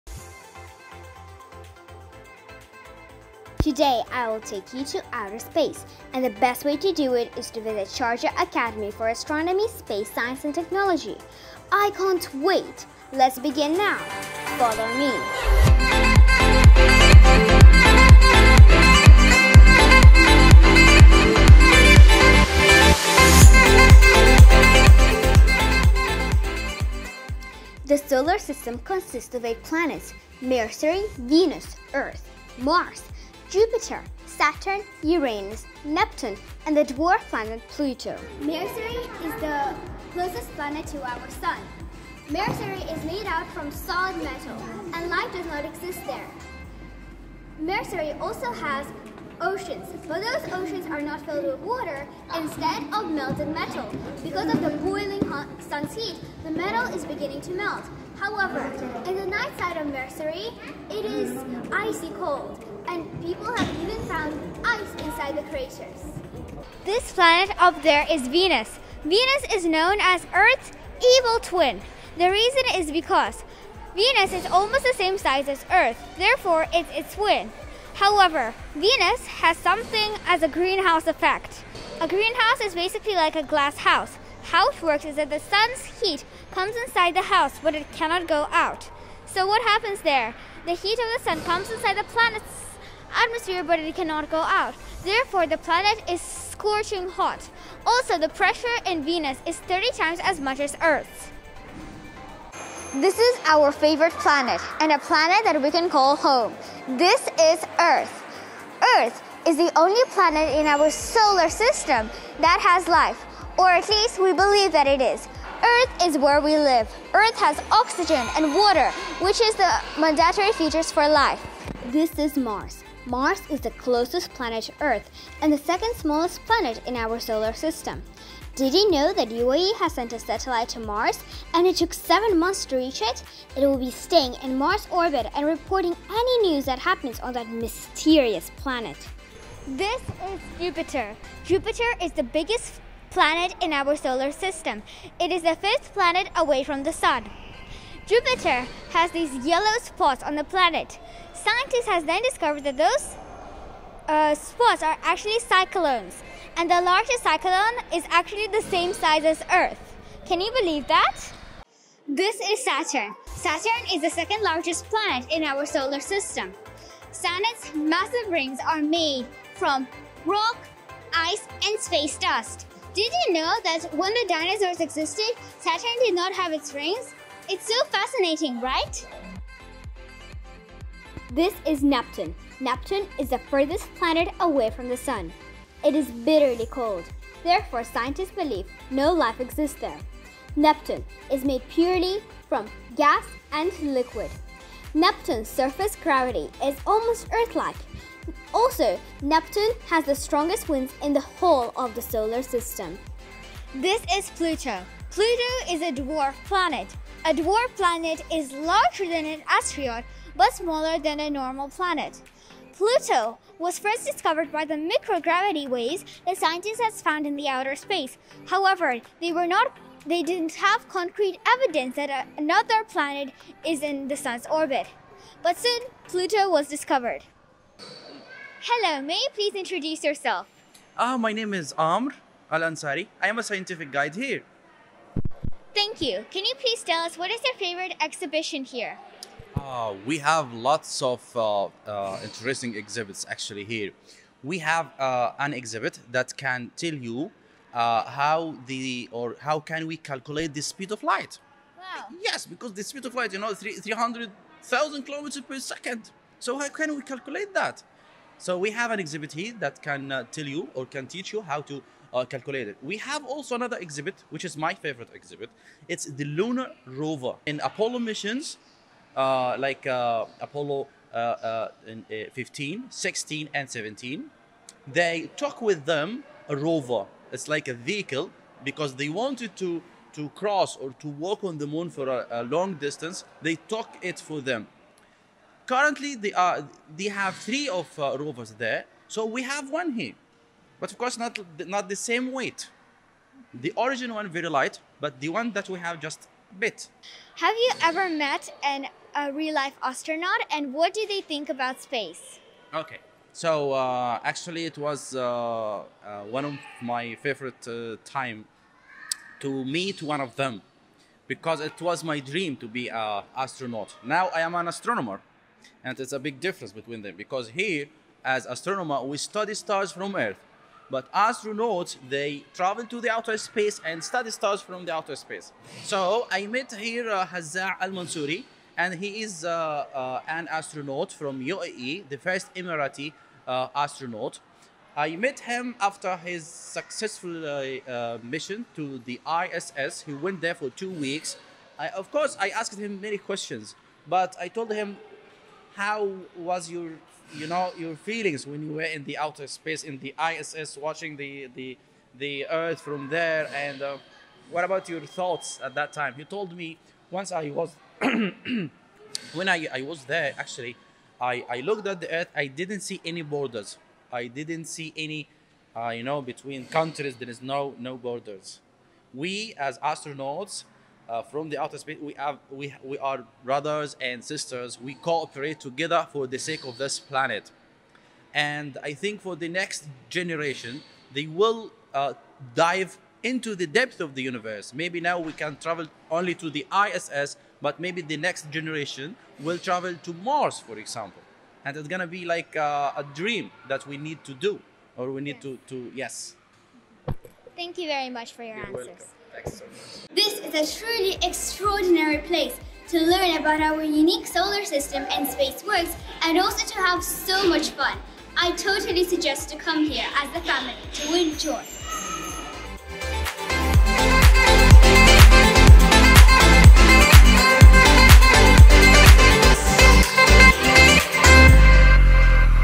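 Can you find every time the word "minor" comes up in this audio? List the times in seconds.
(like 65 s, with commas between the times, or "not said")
not said.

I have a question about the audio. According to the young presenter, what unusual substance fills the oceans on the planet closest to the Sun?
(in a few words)
Melted metal.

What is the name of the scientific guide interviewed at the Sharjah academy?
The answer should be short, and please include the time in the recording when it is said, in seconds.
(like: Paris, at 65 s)
Amr Al Ansari, at 231 s.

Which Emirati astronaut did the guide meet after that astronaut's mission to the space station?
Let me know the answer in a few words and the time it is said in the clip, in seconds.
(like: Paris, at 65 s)
Hazza Al-Mansouri, at 327 s.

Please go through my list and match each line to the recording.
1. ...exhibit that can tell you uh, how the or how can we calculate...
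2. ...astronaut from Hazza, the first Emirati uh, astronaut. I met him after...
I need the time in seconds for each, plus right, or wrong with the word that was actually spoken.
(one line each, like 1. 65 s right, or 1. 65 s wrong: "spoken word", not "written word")
1. 245 s right
2. 330 s wrong: "UAE", not "Hazza".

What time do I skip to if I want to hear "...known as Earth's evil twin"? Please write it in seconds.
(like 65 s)
69 s.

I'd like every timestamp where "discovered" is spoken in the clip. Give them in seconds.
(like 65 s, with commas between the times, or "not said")
152 s, 214 s, 226 s.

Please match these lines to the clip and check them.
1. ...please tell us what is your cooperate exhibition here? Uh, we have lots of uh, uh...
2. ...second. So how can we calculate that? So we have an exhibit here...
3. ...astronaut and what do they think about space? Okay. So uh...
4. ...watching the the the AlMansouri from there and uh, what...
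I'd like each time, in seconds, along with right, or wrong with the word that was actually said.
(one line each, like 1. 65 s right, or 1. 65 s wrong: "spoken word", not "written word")
1. 236 s wrong: "favorite", not "cooperate"
2. 255 s right
3. 299 s right
4. 350 s wrong: "Earth", not "AlMansouri".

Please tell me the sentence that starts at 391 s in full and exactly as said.
And it's gonna be like uh, a dream that we need to do, or we need to, to yes.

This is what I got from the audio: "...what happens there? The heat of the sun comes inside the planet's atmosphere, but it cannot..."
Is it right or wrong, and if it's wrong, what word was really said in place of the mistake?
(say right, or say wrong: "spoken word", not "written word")
right.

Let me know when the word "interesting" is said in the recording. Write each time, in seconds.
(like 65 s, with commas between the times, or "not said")
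242 s.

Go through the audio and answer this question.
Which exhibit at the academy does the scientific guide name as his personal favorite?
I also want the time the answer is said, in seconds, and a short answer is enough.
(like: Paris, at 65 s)
The lunar rover, at 266 s.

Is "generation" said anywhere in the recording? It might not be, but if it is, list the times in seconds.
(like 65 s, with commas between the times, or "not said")
380 s, 388 s.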